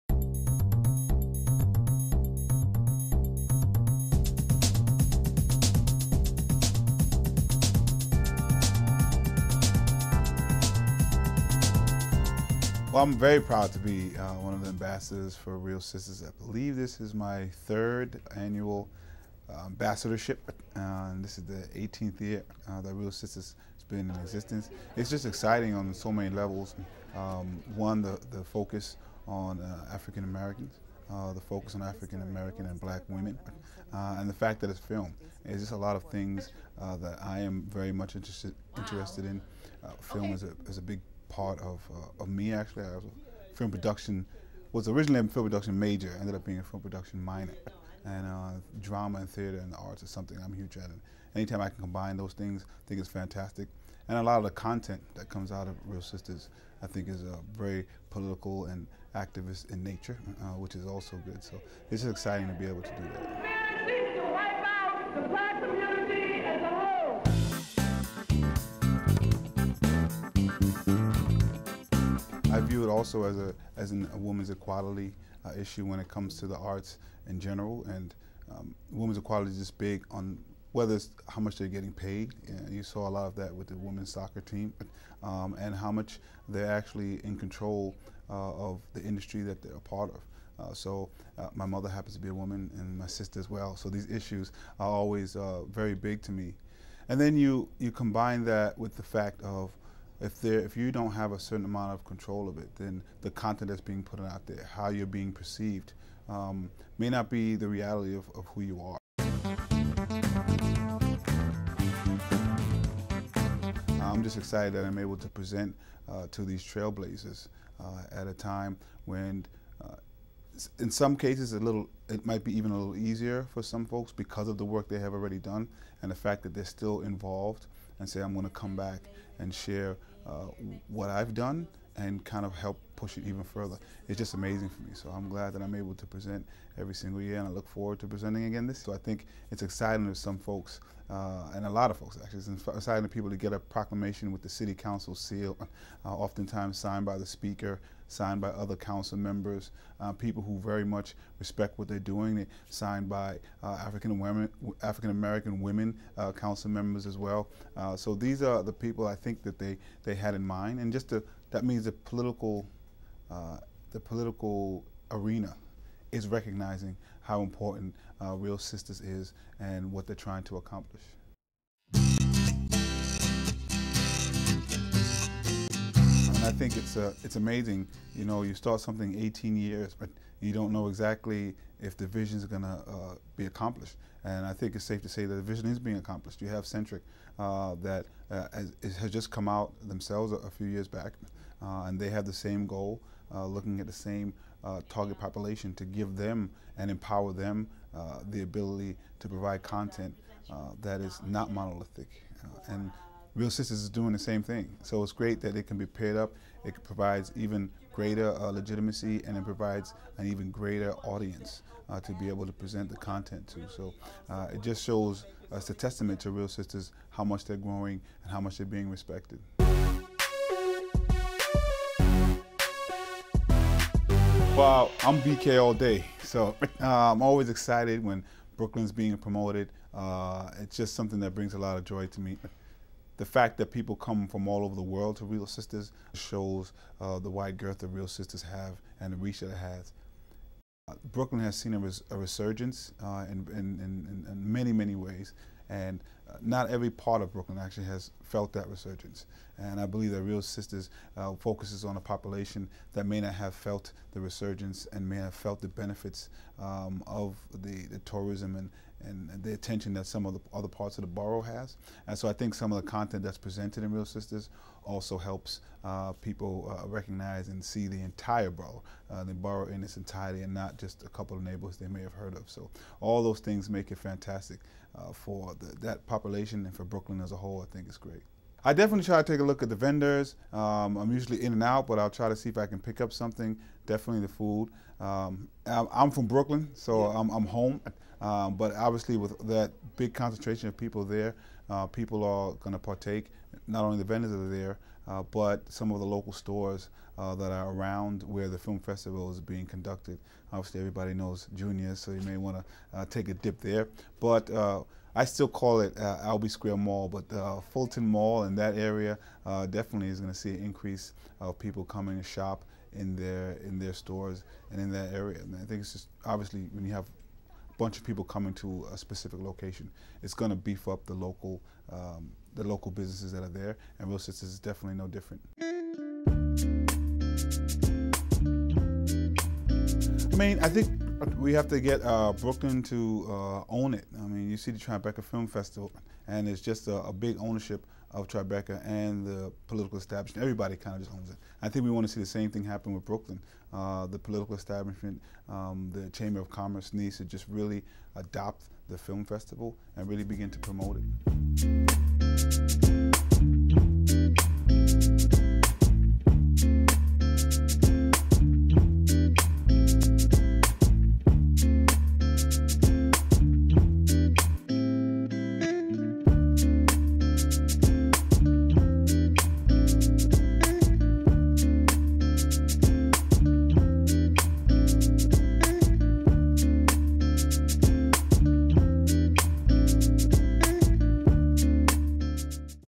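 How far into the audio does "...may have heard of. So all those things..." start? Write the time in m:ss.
4:31.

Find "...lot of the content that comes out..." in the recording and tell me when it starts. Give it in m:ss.
0:54.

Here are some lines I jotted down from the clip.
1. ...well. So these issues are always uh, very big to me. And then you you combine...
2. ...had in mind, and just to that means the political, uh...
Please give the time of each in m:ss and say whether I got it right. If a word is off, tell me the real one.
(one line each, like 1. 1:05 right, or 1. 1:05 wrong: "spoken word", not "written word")
1. 1:33 right
2. 2:40 right.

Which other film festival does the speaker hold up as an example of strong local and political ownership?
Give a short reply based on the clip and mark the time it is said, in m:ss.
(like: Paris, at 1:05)
Tribeca Film Festival, at 5:34.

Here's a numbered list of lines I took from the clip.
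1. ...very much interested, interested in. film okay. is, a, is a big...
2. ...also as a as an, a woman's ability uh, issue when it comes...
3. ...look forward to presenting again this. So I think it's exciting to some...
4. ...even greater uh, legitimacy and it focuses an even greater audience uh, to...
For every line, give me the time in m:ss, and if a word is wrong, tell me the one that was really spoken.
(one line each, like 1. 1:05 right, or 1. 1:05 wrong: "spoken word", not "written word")
1. 0:37 right
2. 1:12 wrong: "equality", not "ability"
3. 2:17 right
4. 3:27 wrong: "provides", not "focuses".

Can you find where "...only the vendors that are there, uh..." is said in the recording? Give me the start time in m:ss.
4:53.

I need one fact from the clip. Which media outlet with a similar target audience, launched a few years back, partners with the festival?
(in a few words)
Centric.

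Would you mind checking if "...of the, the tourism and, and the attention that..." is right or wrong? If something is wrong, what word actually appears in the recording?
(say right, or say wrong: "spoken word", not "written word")
right.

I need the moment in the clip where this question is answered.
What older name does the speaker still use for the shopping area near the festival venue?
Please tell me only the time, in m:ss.
5:06.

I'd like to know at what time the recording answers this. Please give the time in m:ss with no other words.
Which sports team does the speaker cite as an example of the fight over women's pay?
1:23.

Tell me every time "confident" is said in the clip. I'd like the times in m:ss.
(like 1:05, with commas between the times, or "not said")
not said.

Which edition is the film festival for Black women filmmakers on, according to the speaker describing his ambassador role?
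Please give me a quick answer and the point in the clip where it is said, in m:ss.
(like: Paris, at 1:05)
18th, at 0:21.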